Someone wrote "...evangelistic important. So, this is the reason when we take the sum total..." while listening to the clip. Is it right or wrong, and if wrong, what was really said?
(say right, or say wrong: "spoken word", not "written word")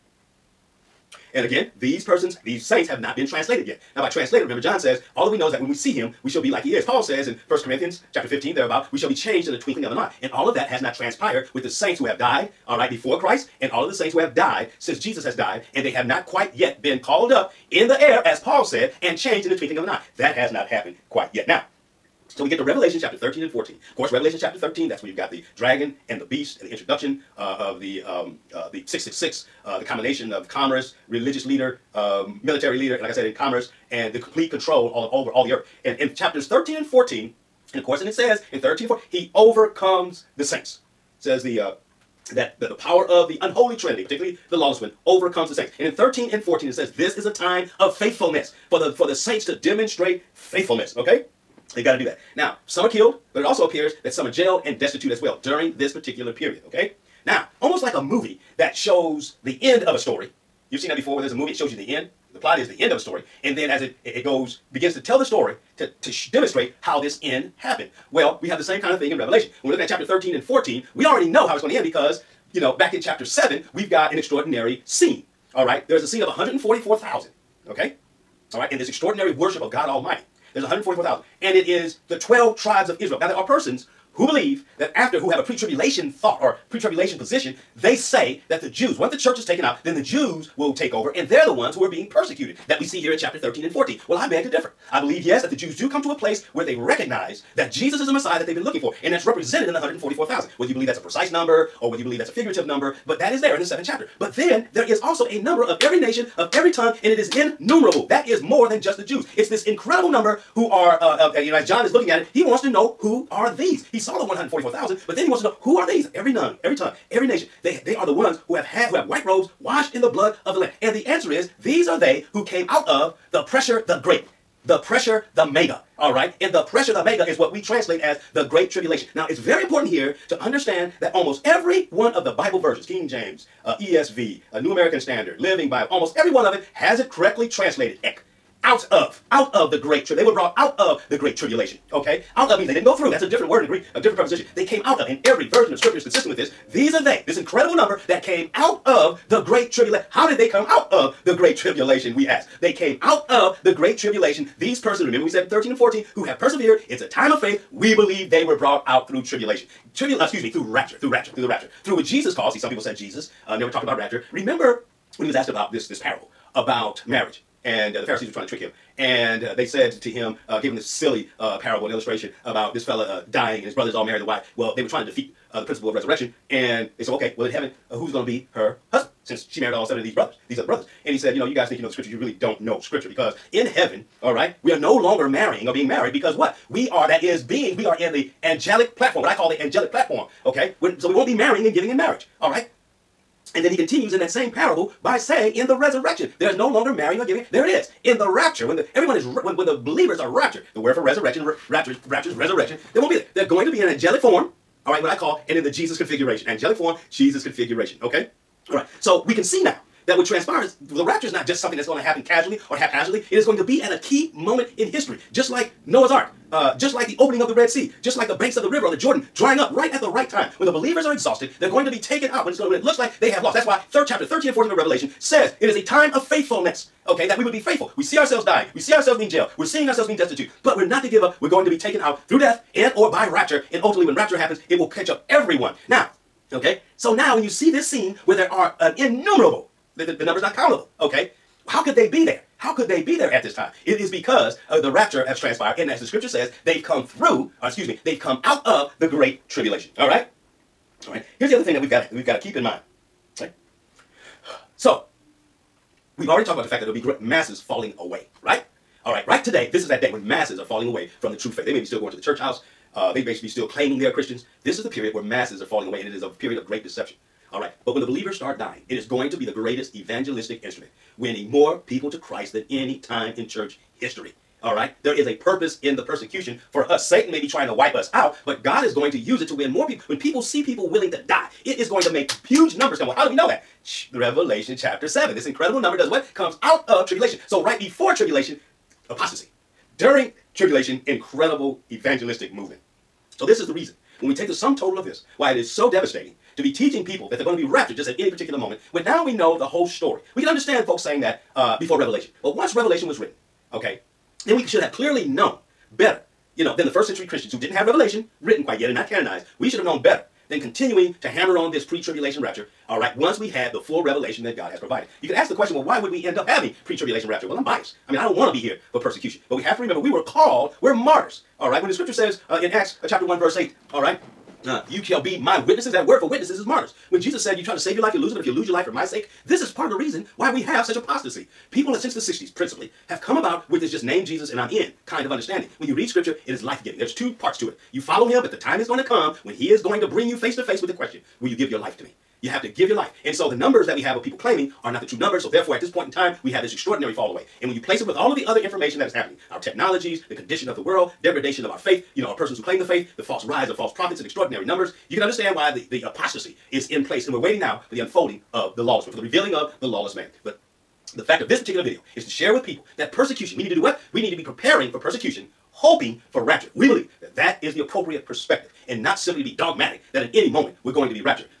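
wrong: "movement", not "important".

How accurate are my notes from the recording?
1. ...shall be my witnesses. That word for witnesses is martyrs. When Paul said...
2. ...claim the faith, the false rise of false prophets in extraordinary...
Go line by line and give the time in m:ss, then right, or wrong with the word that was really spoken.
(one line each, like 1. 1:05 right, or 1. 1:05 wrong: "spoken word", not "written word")
1. 5:25 wrong: "Jesus", not "Paul"
2. 5:52 right.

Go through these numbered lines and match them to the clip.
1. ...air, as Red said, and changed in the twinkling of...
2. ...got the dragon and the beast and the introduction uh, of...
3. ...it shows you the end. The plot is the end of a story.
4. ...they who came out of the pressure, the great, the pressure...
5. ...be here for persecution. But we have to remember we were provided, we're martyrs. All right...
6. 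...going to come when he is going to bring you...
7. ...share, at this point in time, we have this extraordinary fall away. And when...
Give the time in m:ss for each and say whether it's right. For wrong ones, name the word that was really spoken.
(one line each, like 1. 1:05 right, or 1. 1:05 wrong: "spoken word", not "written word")
1. 0:18 wrong: "Paul", not "Red"
2. 0:25 right
3. 1:01 right
4. 2:01 right
5. 5:18 wrong: "called", not "provided"
6. 5:38 right
7. 5:45 wrong: "therefore", not "share".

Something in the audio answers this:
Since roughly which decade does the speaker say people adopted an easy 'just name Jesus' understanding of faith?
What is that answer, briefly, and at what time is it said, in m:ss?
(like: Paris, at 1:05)
the 60s, at 5:32.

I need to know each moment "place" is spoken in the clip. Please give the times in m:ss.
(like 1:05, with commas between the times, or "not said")
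1:36, 5:47, 5:57.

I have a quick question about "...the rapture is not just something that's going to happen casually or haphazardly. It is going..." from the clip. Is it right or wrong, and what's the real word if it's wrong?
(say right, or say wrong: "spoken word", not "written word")
right.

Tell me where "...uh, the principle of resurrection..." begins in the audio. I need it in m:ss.
2:55.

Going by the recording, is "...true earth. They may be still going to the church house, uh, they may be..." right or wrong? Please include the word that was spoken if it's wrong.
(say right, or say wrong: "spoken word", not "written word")
wrong: "faith", not "earth".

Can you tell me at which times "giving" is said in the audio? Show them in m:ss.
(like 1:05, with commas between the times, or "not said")
3:11, 3:17, 5:36.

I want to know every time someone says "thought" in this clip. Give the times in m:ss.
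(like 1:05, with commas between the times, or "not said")
1:26.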